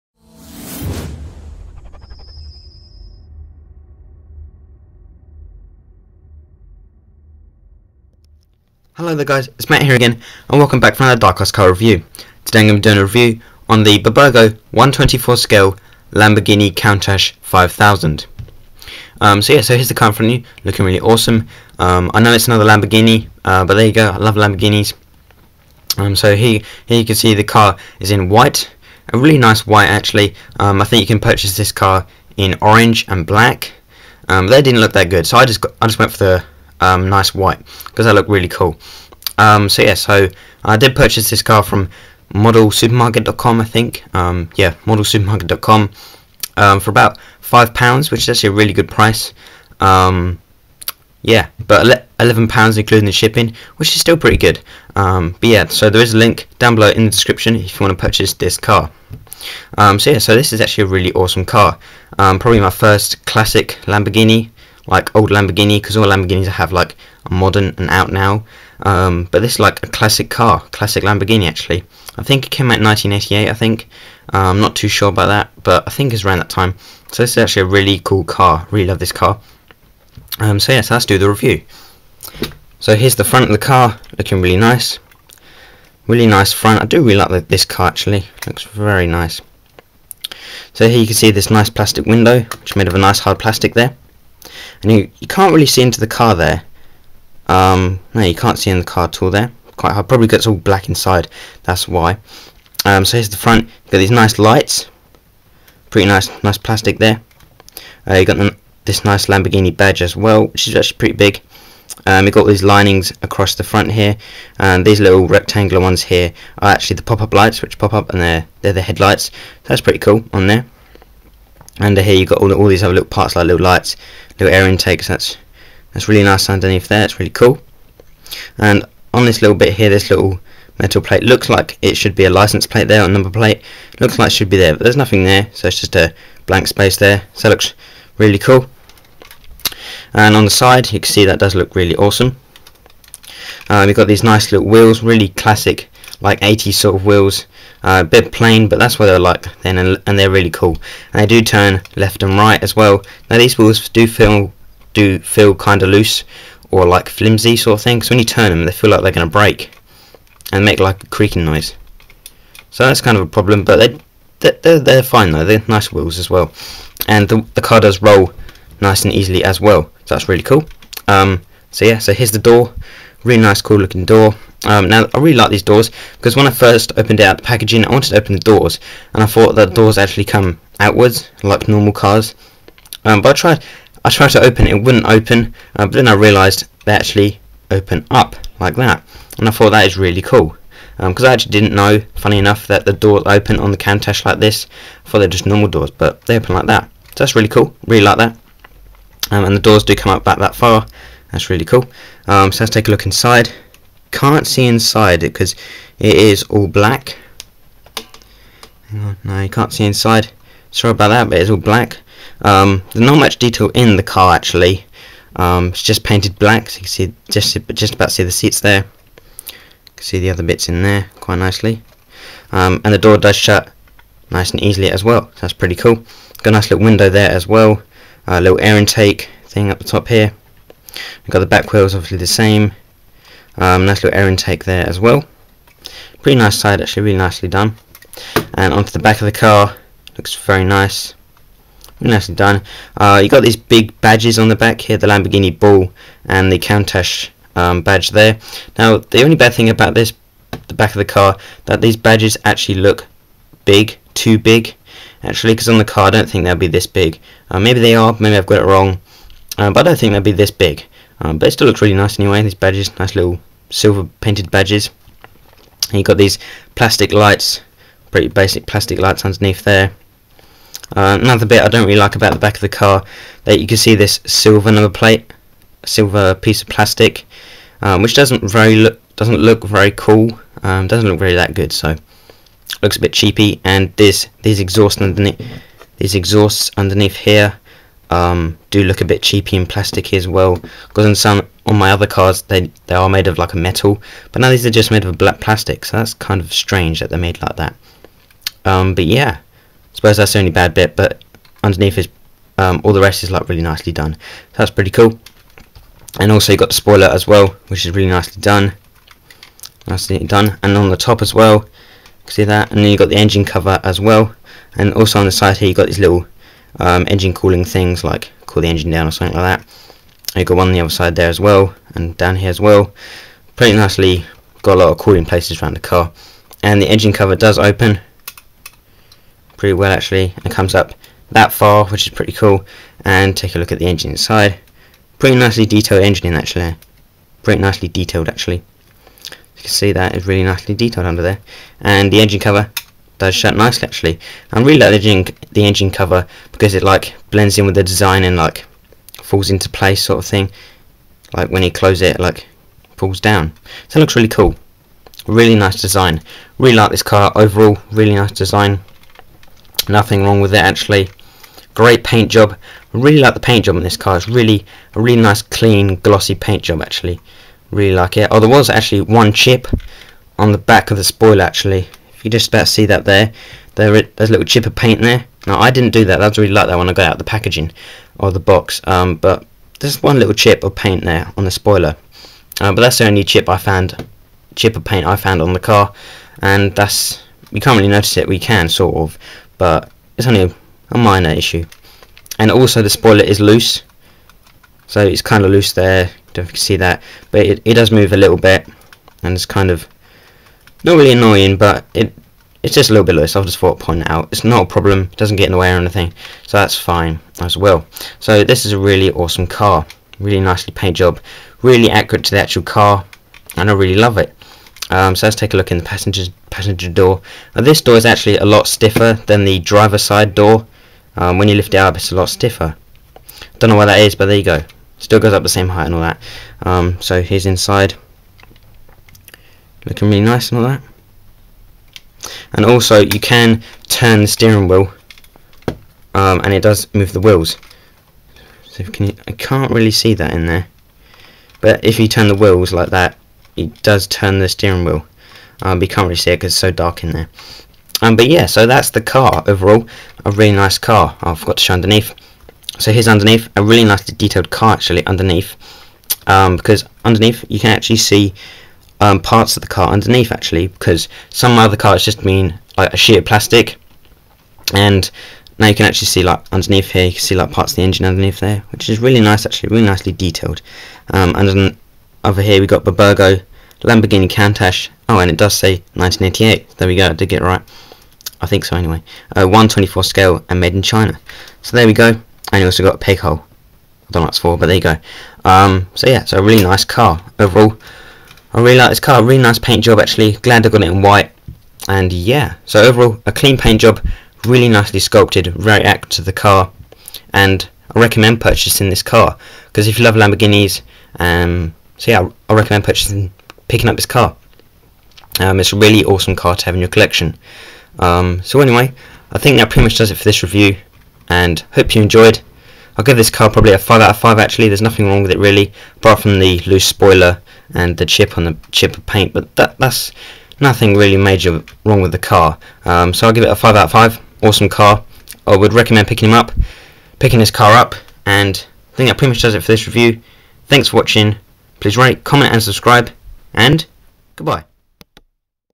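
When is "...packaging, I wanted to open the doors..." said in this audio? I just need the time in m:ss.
2:57.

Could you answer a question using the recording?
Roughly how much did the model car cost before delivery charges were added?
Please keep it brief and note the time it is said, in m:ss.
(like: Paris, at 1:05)
5 pounds, at 0:47.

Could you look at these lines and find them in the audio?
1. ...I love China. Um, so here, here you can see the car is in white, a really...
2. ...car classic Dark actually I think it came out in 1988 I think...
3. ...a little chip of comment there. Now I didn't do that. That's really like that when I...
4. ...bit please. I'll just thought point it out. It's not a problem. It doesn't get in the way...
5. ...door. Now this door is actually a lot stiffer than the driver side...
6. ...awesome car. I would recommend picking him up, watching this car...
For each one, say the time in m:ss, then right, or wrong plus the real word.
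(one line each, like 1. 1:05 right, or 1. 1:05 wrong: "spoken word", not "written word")
1. 0:24 wrong: "Lamborghinis", not "China"
2. 1:10 wrong: "Lamborghini", not "Dark"
3. 6:14 wrong: "paint", not "comment"
4. 6:43 wrong: "loose", not "please"
5. 6:56 right
6. 8:44 wrong: "picking", not "watching".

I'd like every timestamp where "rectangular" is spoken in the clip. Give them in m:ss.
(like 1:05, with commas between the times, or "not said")
1:55.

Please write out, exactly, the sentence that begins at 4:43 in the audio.
And this these exhausts underneath these exhausts underneath here um, do look a bit cheapy and plasticky as well.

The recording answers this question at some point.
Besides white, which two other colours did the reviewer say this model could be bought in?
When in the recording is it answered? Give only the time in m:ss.
0:32.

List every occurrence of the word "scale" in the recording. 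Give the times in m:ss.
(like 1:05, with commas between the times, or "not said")
0:15, 8:00.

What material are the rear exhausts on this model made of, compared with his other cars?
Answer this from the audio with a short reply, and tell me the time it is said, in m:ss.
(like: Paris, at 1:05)
black plastic, at 4:55.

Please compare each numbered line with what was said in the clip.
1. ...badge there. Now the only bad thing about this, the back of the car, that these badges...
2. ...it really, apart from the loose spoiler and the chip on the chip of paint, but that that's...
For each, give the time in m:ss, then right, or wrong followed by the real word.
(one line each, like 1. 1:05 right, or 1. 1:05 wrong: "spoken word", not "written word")
1. 4:07 right
2. 8:35 right.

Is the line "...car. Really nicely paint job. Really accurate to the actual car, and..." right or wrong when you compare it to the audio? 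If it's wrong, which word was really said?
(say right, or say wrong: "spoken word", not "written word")
right.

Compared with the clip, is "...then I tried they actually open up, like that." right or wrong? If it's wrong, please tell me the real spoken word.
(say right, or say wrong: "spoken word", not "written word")
wrong: "realised", not "tried".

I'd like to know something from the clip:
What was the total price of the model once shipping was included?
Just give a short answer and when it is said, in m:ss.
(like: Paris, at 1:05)
11 pounds, at 0:52.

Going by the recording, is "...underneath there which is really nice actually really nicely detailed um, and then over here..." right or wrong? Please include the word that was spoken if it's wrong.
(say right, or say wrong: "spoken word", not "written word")
right.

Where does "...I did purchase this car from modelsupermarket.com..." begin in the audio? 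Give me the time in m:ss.
0:40.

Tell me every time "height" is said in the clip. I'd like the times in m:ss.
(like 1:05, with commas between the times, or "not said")
7:05.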